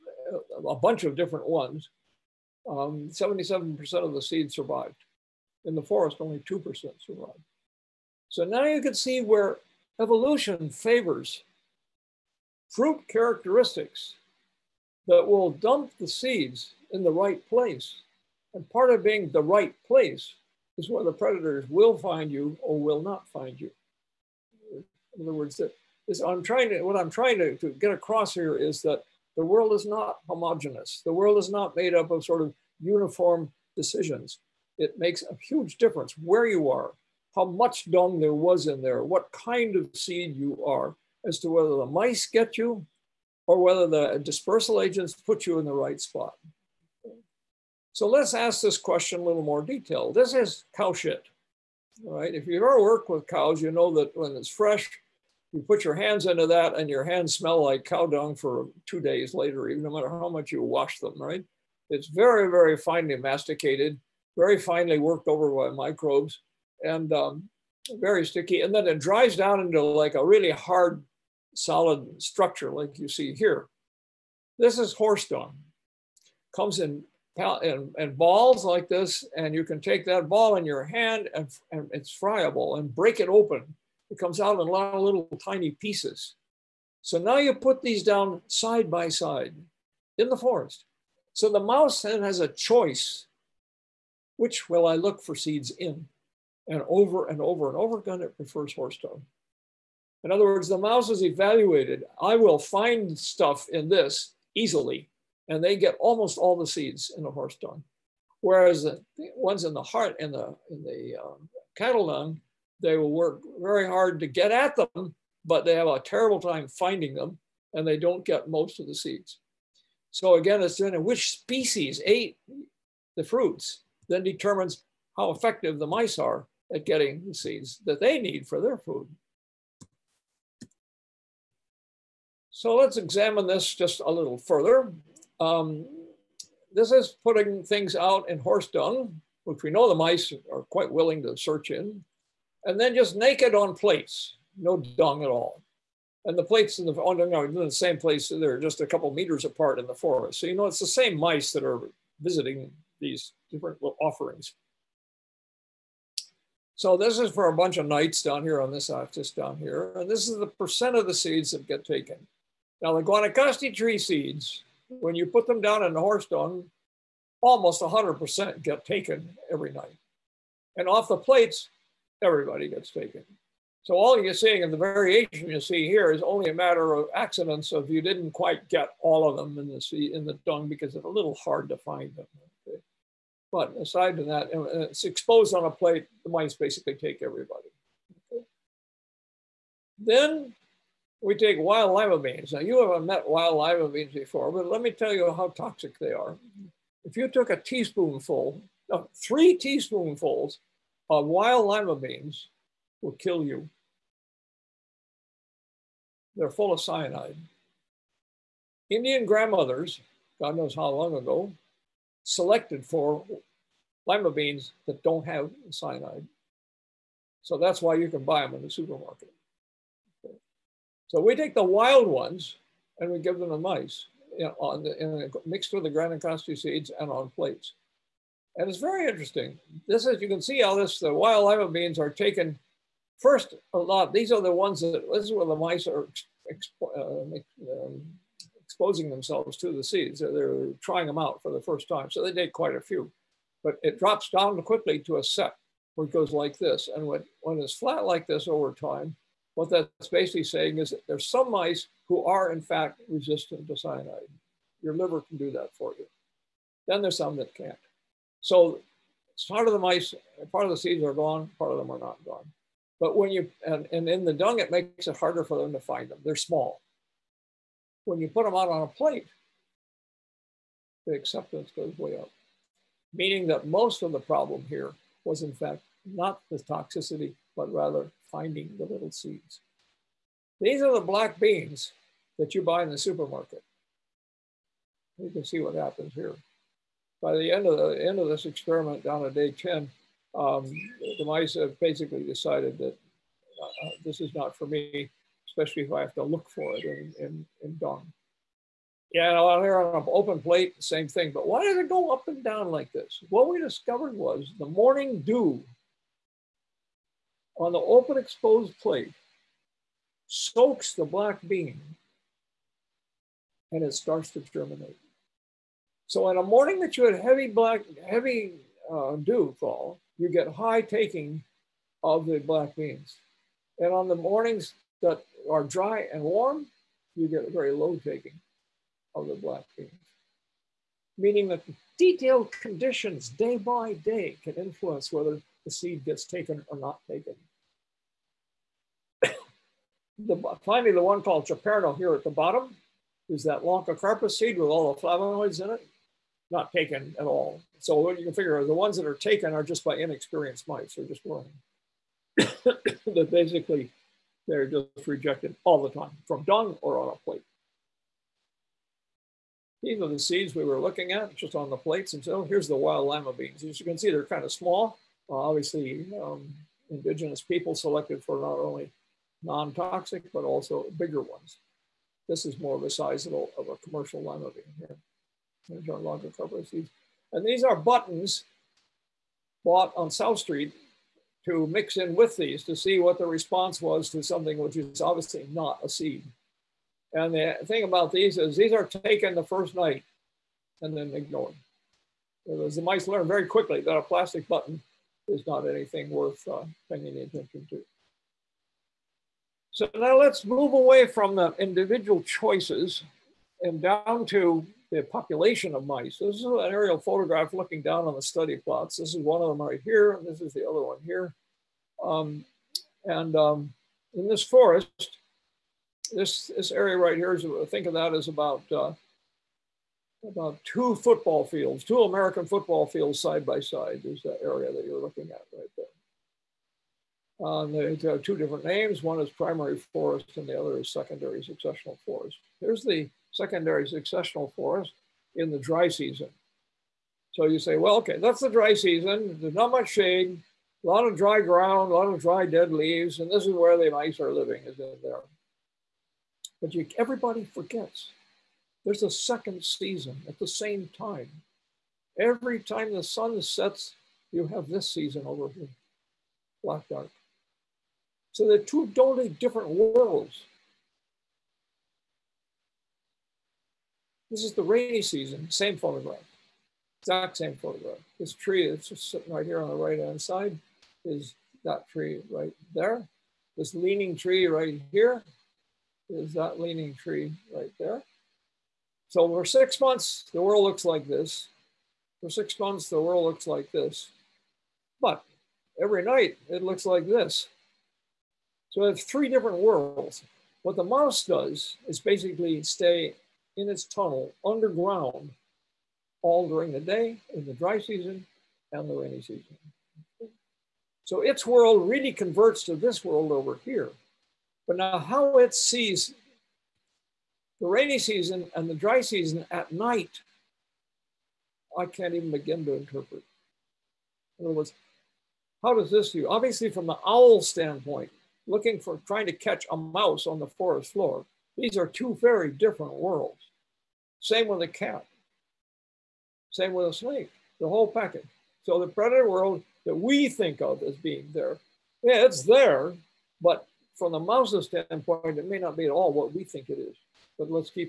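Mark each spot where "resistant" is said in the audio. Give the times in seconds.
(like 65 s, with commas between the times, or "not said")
253 s.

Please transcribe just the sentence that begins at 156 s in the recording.
So this is for a bunch of nights down here on this axis down here.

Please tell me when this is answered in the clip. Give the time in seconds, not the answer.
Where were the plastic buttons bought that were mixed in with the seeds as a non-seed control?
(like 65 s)
380 s.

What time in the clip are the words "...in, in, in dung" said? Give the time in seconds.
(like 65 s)
296 s.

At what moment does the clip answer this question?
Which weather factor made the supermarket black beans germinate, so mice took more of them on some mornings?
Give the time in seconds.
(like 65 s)
304 s.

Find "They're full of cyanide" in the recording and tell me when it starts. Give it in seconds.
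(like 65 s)
206 s.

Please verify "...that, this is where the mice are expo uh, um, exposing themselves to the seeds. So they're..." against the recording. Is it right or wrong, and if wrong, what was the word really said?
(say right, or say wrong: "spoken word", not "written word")
right.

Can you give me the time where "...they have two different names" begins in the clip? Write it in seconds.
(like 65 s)
427 s.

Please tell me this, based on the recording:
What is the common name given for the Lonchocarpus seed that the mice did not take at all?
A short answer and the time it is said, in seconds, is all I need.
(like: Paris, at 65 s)
Chaperno, at 341 s.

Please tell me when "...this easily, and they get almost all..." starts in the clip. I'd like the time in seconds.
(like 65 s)
103 s.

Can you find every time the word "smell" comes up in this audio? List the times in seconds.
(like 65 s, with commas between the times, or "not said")
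57 s.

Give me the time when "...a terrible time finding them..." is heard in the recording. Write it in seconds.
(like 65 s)
115 s.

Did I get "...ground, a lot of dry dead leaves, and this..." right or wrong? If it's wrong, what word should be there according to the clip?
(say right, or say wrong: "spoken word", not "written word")
right.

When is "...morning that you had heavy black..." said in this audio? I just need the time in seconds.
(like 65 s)
316 s.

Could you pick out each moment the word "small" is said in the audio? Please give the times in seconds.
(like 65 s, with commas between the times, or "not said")
266 s, 364 s.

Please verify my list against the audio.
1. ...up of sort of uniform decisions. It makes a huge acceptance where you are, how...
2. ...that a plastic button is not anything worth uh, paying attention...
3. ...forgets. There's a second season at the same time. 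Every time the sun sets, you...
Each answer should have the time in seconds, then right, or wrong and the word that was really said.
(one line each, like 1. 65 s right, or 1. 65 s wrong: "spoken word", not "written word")
1. 31 s wrong: "difference", not "acceptance"
2. 393 s right
3. 447 s right.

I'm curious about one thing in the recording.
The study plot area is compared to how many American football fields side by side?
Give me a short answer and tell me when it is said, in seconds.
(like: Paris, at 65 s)
2, at 421 s.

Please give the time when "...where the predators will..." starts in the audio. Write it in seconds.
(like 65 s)
20 s.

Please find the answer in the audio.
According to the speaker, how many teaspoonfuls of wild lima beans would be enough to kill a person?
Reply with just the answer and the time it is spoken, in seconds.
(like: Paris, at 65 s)
3, at 199 s.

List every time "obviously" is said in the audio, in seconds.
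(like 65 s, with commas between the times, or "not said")
365 s, 385 s, 516 s.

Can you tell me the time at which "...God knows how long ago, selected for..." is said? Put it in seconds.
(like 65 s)
210 s.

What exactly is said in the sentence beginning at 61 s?
It's very, very finely masticated, very finely worked over by microbes and um, very sticky.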